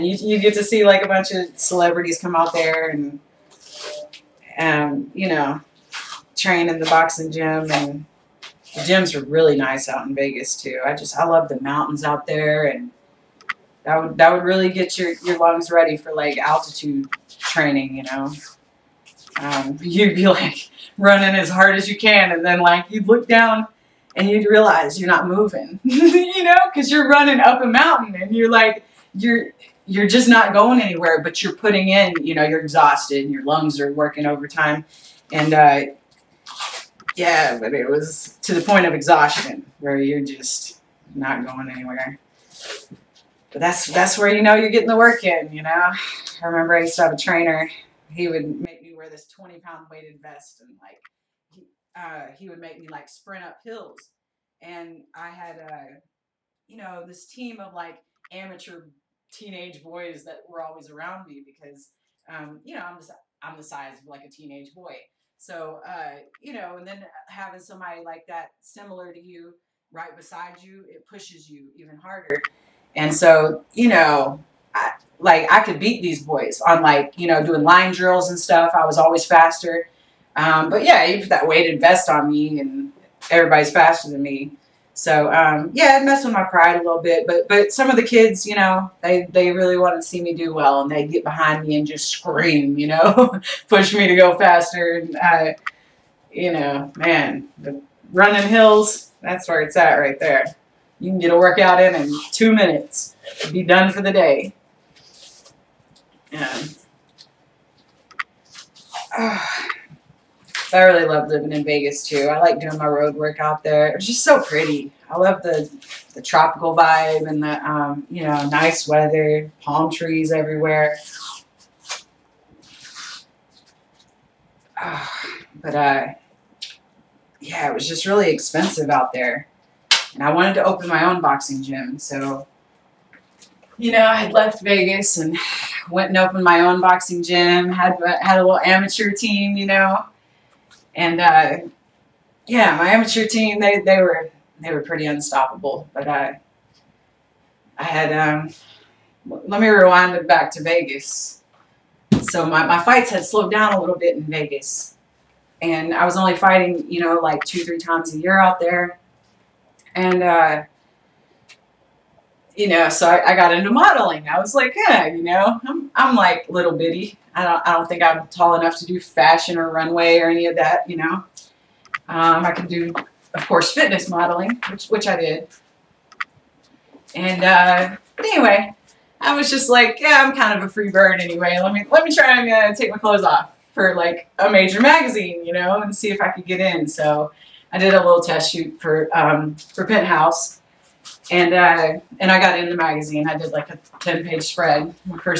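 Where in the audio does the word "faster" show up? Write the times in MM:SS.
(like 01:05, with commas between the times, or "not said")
01:19, 01:23, 01:34.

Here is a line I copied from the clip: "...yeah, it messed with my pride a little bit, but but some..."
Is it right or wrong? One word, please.
right.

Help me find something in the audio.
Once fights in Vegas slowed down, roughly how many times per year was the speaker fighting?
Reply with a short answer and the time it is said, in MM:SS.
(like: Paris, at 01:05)
2 or 3, at 02:37.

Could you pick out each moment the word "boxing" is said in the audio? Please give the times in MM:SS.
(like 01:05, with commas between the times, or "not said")
00:06, 02:11, 02:16.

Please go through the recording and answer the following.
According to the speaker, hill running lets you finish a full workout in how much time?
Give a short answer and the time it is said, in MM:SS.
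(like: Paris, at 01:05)
2 minutes, at 01:42.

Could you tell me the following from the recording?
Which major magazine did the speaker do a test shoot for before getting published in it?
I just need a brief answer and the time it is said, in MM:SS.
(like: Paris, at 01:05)
Penthouse, at 03:09.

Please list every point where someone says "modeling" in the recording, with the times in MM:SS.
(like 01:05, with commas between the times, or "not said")
02:43, 02:54.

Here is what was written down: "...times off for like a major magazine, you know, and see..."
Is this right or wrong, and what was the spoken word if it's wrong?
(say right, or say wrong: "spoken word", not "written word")
wrong: "clothes", not "times".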